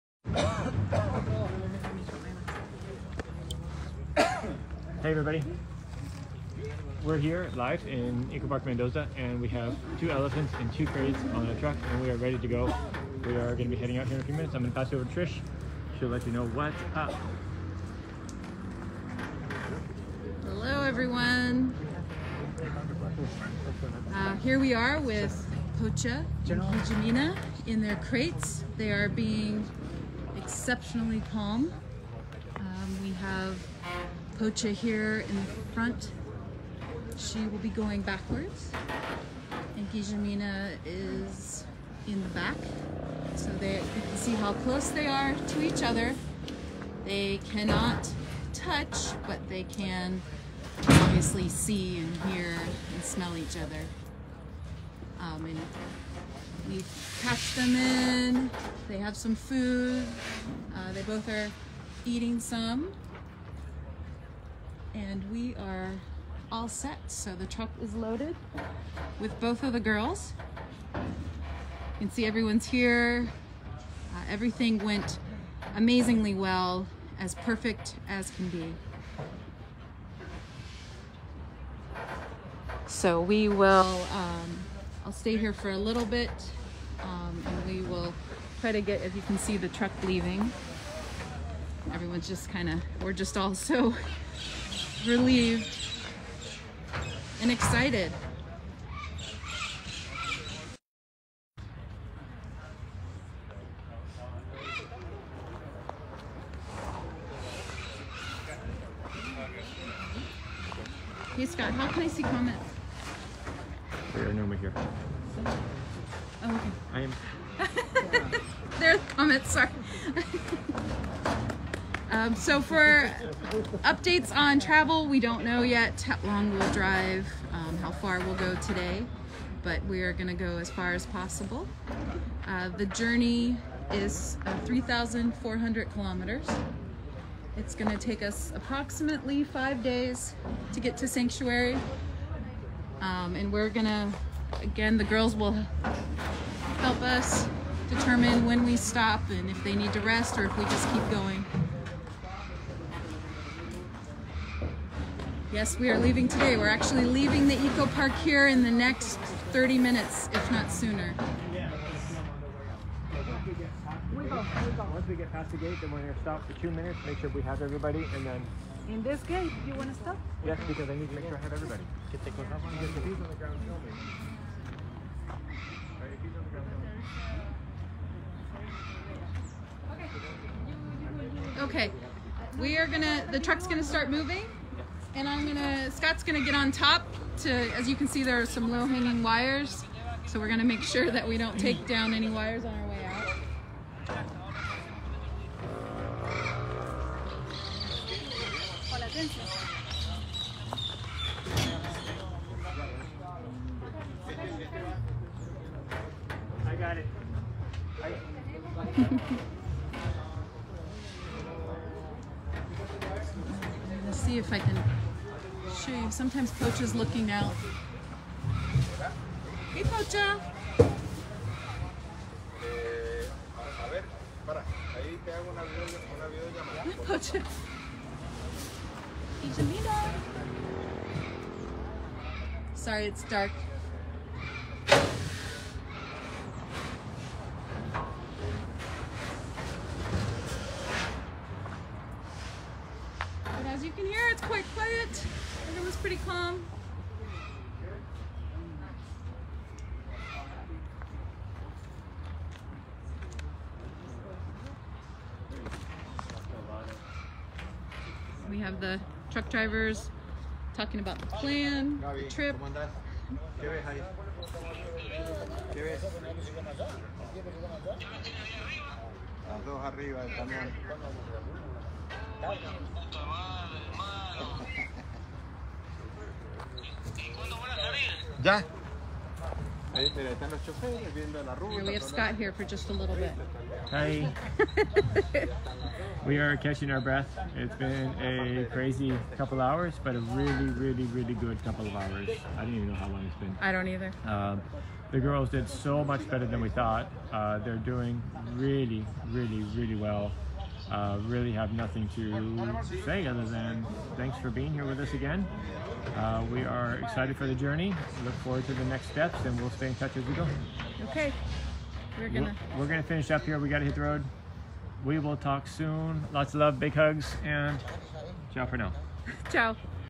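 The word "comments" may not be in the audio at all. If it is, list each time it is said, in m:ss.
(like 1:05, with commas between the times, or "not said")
1:52, 1:59.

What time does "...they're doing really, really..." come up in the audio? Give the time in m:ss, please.
4:57.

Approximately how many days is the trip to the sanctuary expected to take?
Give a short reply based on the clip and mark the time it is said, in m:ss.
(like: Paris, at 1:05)
5, at 2:19.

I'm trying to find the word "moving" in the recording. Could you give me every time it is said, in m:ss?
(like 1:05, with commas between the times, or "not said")
3:04.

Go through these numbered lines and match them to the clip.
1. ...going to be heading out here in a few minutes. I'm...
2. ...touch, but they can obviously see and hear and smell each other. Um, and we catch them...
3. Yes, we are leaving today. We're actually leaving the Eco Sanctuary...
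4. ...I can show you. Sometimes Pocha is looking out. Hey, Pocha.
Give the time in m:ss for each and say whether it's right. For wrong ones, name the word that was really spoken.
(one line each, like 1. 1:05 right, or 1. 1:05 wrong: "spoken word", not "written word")
1. 0:13 right
2. 0:48 right
3. 2:35 wrong: "Park", not "Sanctuary"
4. 3:34 right.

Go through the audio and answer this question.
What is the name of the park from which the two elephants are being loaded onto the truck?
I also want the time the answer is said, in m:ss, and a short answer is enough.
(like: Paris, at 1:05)
Eco Park Mendoza, at 0:08.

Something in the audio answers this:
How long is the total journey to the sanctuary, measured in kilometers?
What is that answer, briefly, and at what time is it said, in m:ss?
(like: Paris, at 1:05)
3,400 kilometers, at 2:14.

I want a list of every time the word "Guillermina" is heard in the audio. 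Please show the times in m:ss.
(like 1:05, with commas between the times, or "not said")
0:26, 0:39.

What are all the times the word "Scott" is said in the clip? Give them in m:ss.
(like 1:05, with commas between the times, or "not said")
1:51, 3:05, 4:42.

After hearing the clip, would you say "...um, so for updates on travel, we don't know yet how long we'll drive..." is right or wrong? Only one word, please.
right.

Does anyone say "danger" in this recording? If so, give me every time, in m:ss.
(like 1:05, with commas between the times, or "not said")
not said.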